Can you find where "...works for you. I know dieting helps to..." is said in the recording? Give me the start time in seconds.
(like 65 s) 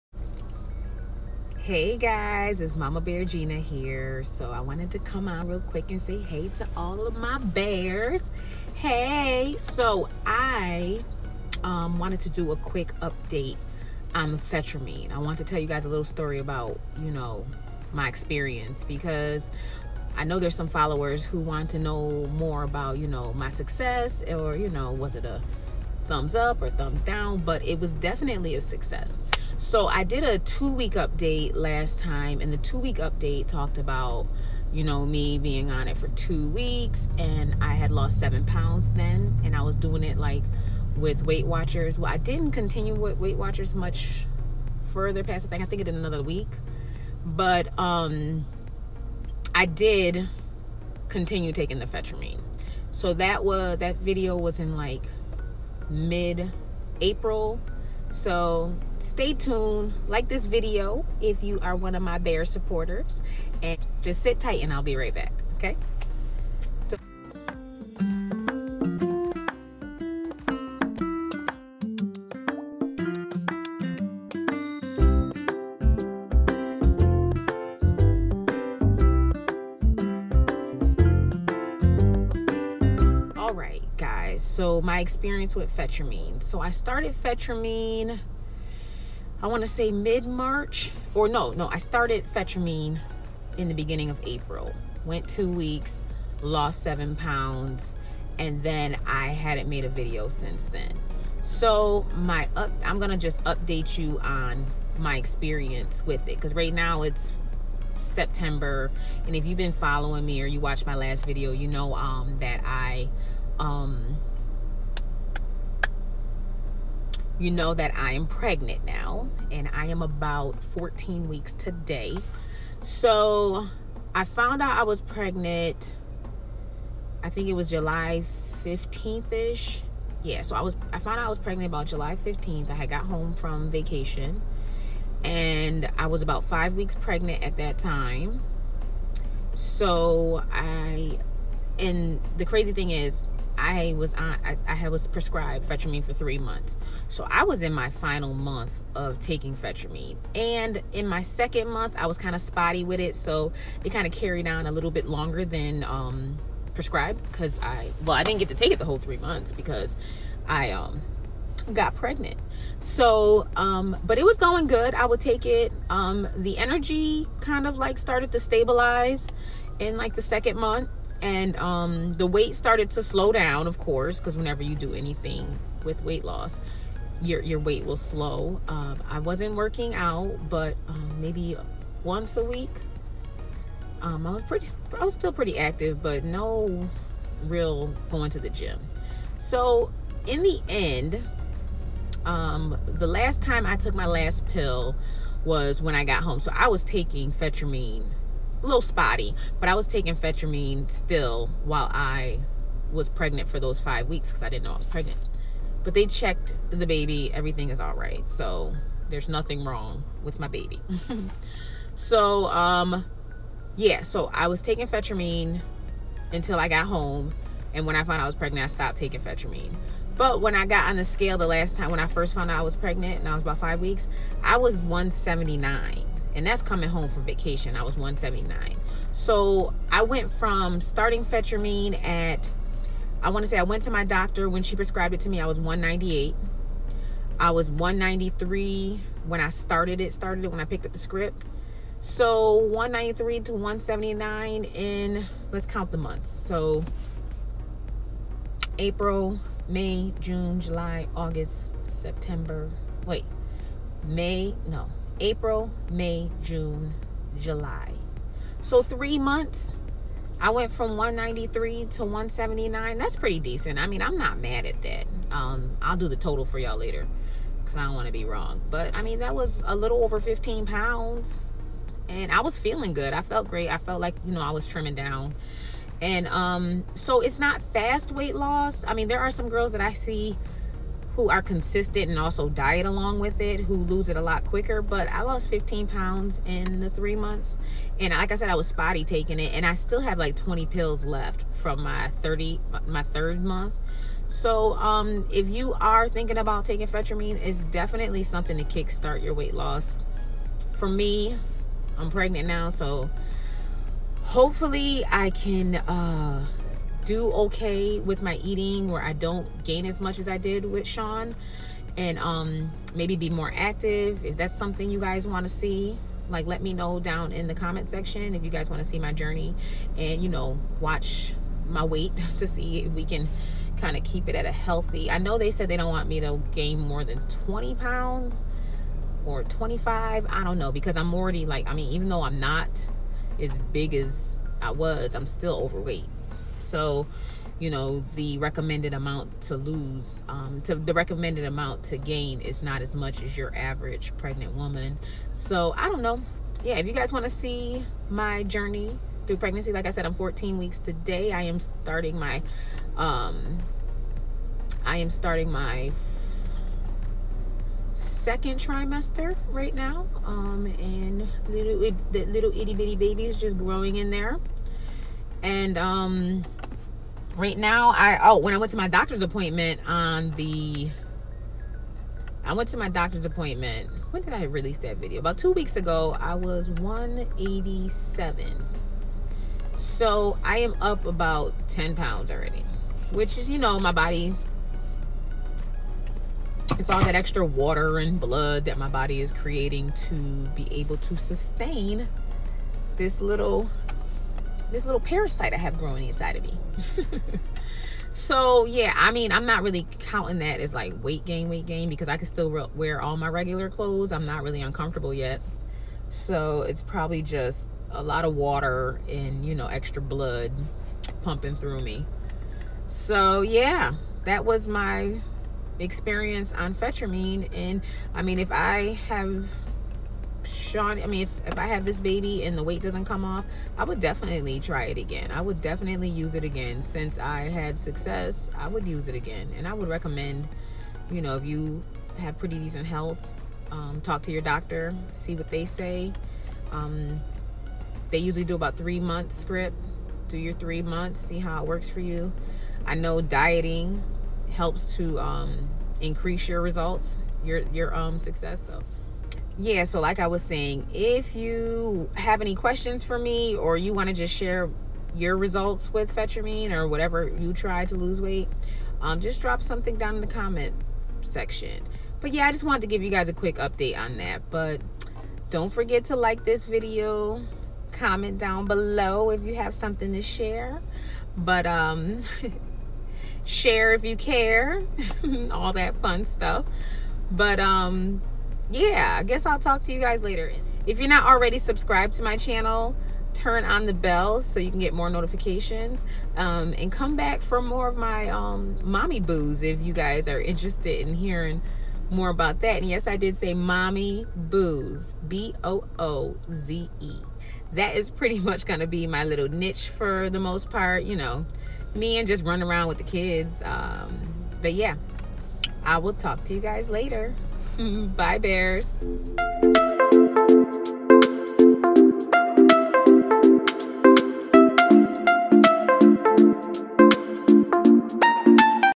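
441 s.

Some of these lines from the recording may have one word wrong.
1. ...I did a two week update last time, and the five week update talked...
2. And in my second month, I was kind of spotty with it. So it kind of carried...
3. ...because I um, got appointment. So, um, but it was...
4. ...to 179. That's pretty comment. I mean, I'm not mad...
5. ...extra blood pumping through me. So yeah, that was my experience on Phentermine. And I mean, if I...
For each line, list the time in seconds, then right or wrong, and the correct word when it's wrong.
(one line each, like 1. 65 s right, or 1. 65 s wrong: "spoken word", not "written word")
1. 29 s wrong: "two", not "five"
2. 150 s right
3. 159 s wrong: "pregnant", not "appointment"
4. 261 s wrong: "decent", not "comment"
5. 409 s right.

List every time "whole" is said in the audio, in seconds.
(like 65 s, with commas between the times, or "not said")
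158 s.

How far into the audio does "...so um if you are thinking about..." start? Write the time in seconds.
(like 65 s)
294 s.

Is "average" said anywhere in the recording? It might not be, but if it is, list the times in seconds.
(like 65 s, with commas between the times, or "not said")
343 s.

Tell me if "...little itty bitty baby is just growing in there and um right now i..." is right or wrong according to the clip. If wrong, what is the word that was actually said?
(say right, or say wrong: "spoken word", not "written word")
right.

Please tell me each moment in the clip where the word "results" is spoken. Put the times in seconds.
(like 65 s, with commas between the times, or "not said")
446 s, 455 s.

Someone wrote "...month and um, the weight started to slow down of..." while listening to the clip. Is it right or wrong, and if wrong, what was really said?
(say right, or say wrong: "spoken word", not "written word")
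right.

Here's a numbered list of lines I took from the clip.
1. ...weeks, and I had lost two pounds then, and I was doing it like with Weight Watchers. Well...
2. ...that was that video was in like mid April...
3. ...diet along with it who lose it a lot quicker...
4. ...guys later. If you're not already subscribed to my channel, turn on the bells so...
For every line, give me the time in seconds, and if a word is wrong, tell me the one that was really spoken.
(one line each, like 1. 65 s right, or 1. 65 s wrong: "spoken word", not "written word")
1. 36 s wrong: "seven", not "two"
2. 53 s right
3. 282 s right
4. 479 s right.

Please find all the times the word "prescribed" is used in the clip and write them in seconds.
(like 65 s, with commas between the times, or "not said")
145 s, 156 s, 234 s.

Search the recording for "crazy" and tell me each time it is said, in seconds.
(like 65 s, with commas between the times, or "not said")
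142 s.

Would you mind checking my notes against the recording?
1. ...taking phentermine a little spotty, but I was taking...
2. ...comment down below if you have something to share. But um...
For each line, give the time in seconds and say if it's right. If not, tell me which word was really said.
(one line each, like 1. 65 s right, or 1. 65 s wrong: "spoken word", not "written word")
1. 196 s right
2. 467 s right.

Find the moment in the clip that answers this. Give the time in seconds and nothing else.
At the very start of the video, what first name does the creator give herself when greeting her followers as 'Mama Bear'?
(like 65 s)
3 s.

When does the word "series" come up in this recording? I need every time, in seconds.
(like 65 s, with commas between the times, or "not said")
not said.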